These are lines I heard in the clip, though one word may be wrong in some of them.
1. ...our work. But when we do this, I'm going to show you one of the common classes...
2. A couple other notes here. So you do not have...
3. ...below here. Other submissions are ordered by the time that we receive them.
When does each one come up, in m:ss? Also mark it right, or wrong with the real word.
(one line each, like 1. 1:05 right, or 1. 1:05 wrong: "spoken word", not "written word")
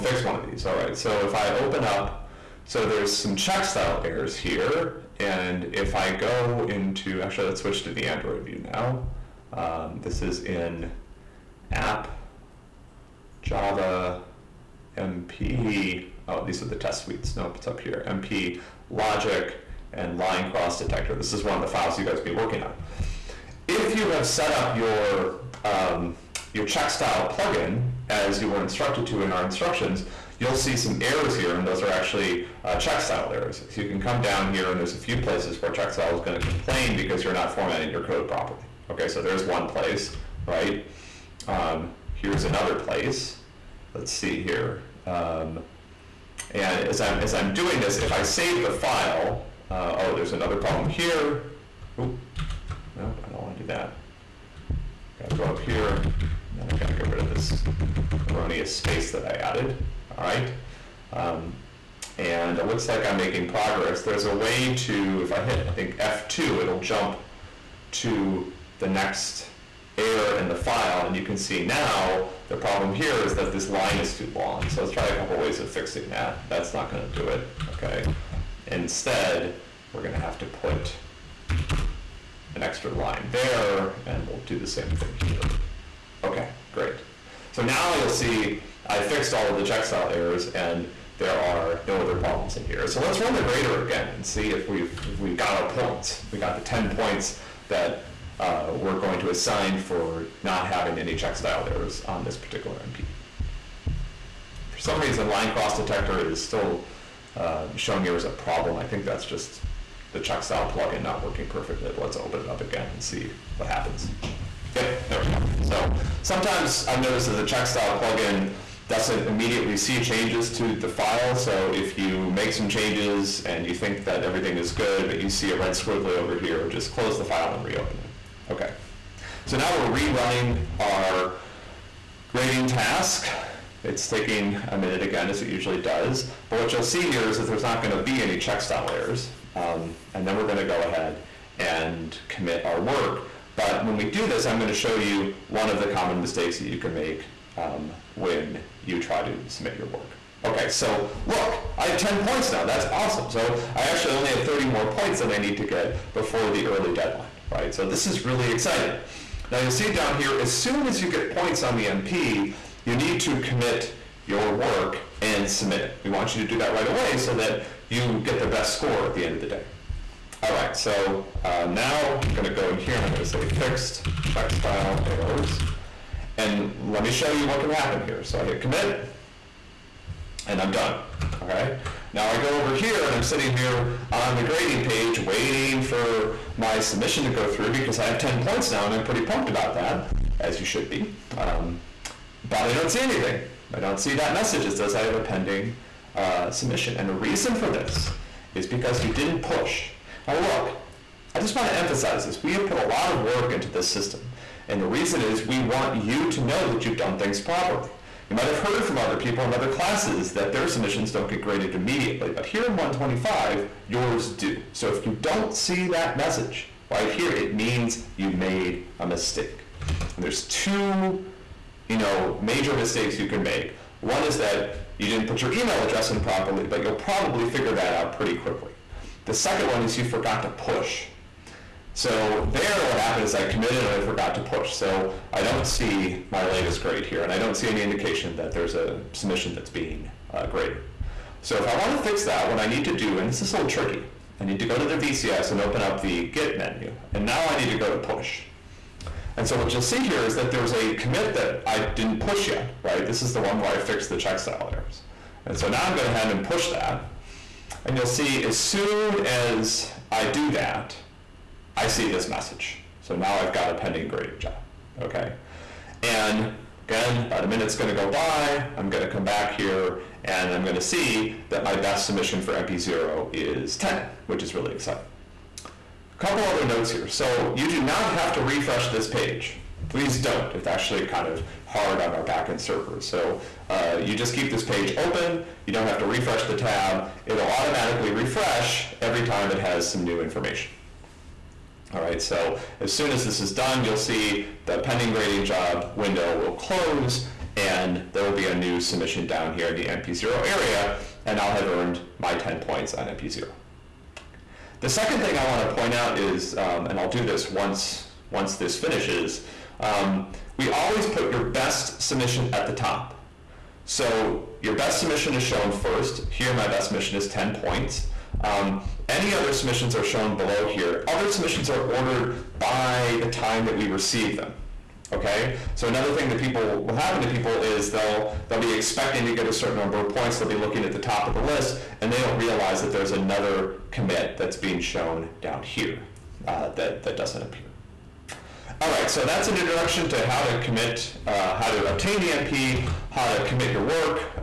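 1. 2:22 wrong: "mistakes", not "classes"
2. 4:35 right
3. 5:20 right.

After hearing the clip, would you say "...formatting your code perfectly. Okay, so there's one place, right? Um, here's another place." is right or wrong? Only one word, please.
wrong.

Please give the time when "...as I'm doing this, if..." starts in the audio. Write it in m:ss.
0:47.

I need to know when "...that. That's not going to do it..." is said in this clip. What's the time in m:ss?
1:16.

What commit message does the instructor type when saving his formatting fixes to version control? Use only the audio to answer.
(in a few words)
fixed checkstyle errors.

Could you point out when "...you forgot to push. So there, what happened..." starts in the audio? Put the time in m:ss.
3:49.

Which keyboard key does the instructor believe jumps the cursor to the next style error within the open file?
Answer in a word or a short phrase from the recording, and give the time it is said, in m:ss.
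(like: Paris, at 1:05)
F2, at 1:05.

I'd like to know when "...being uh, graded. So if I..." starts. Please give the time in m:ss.
3:59.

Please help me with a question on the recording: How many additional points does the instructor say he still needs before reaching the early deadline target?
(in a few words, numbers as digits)
30.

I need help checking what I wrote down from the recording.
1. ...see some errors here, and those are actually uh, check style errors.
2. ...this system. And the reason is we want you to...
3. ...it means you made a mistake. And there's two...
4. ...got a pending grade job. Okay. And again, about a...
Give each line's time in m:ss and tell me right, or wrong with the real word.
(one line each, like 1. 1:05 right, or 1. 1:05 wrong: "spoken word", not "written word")
1. 0:30 right
2. 3:23 right
3. 3:37 right
4. 4:23 right.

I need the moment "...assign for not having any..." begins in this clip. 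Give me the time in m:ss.
1:39.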